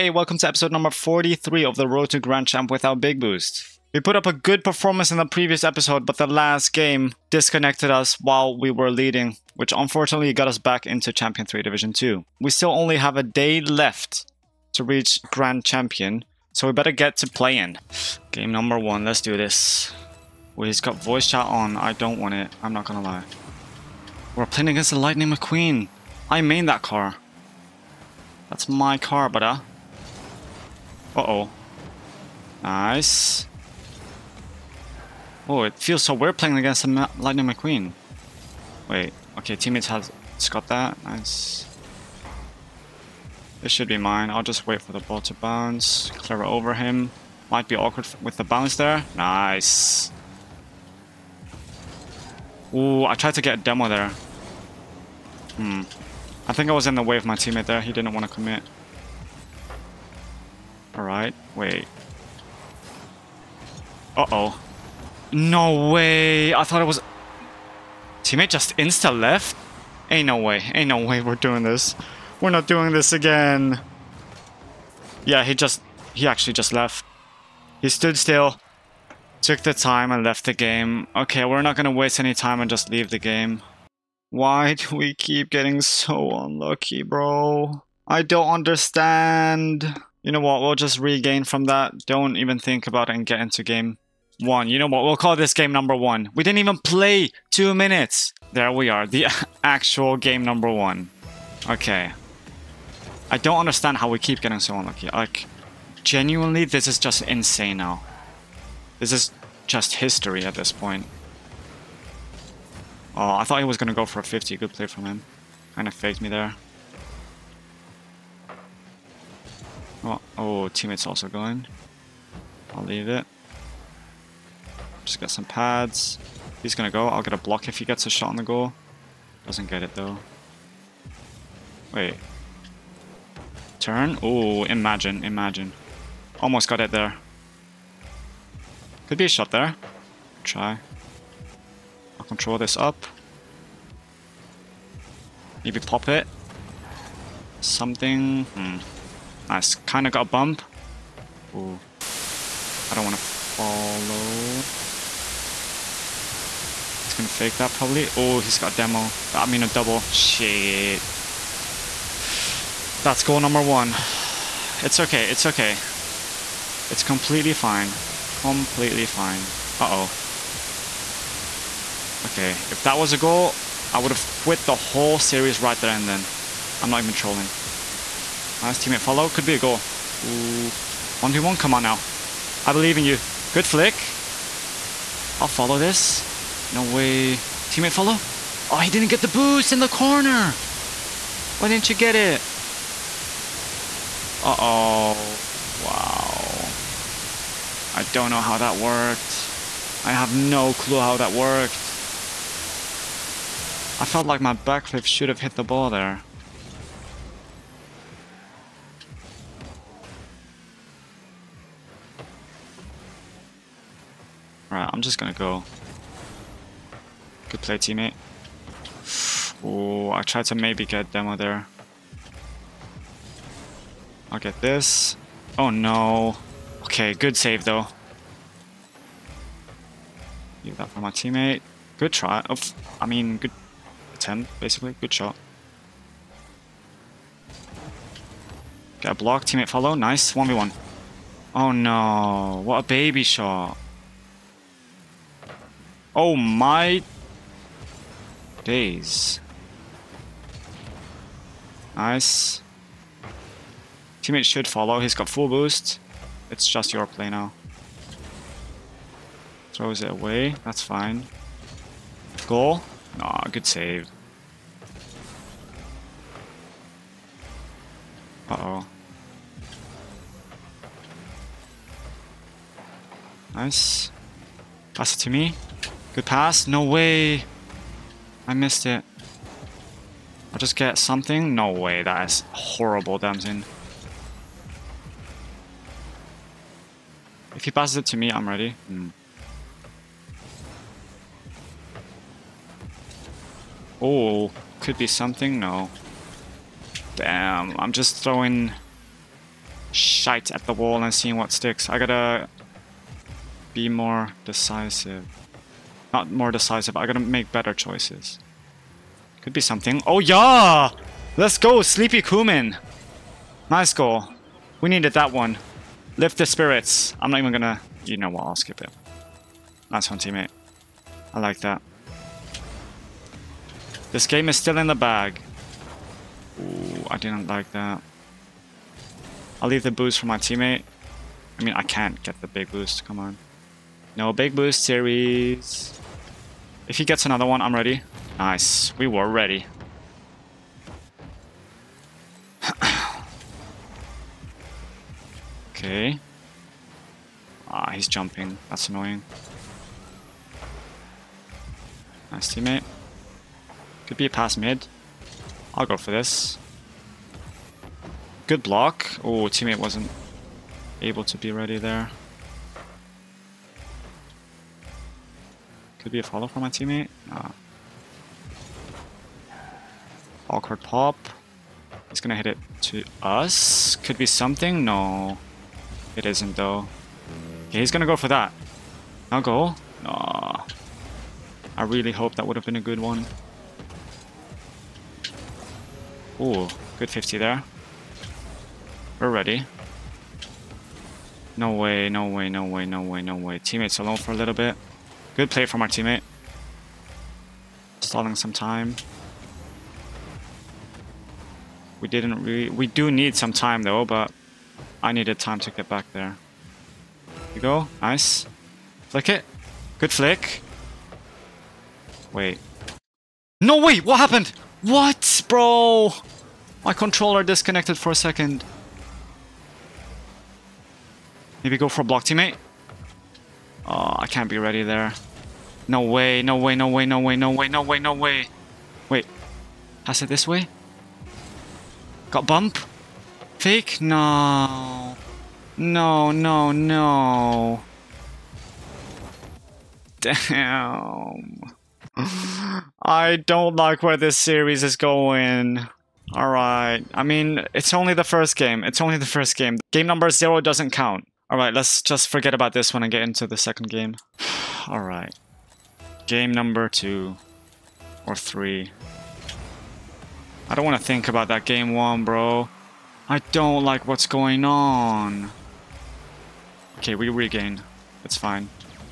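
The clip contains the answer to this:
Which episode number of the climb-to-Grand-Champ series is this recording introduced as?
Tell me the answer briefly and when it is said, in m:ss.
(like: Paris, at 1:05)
43, at 0:00.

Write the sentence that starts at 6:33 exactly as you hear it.
Teammates alone for a little bit.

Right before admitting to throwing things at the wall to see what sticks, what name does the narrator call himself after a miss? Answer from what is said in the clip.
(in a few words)
Damsin.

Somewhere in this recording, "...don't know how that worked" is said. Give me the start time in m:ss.
3:18.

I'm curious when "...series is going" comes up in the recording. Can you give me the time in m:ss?
7:24.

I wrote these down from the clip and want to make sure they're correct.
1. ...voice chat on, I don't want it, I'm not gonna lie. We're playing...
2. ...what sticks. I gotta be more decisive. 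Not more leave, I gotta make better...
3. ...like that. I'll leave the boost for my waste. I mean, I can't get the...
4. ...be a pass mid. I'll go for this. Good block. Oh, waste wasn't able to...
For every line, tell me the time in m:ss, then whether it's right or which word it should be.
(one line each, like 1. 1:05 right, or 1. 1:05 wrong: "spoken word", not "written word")
1. 0:21 right
2. 5:01 wrong: "decisive", not "leave"
3. 5:27 wrong: "teammate", not "waste"
4. 5:54 wrong: "teammate", not "waste".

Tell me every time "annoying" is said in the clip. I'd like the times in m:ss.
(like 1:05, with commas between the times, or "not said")
5:48.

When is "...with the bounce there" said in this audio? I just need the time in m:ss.
0:48.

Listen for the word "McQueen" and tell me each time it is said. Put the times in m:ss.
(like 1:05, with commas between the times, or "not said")
0:25, 0:37.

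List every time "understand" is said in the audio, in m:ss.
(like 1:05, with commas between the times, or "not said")
1:28, 1:43.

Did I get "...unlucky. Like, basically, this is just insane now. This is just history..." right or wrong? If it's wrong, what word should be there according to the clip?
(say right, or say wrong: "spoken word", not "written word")
wrong: "genuinely", not "basically".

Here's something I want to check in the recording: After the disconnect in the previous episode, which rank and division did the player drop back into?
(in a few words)
Champion 3 Division 2.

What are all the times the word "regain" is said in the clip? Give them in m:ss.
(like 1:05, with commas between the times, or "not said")
1:30, 7:47.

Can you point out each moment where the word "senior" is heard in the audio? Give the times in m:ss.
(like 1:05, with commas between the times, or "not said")
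not said.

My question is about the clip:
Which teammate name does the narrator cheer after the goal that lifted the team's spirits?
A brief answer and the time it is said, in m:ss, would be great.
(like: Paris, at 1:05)
Sleepy Kumin, at 5:11.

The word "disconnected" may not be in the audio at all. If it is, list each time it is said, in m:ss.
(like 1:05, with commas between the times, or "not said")
0:07, 6:57.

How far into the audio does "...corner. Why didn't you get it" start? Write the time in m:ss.
3:09.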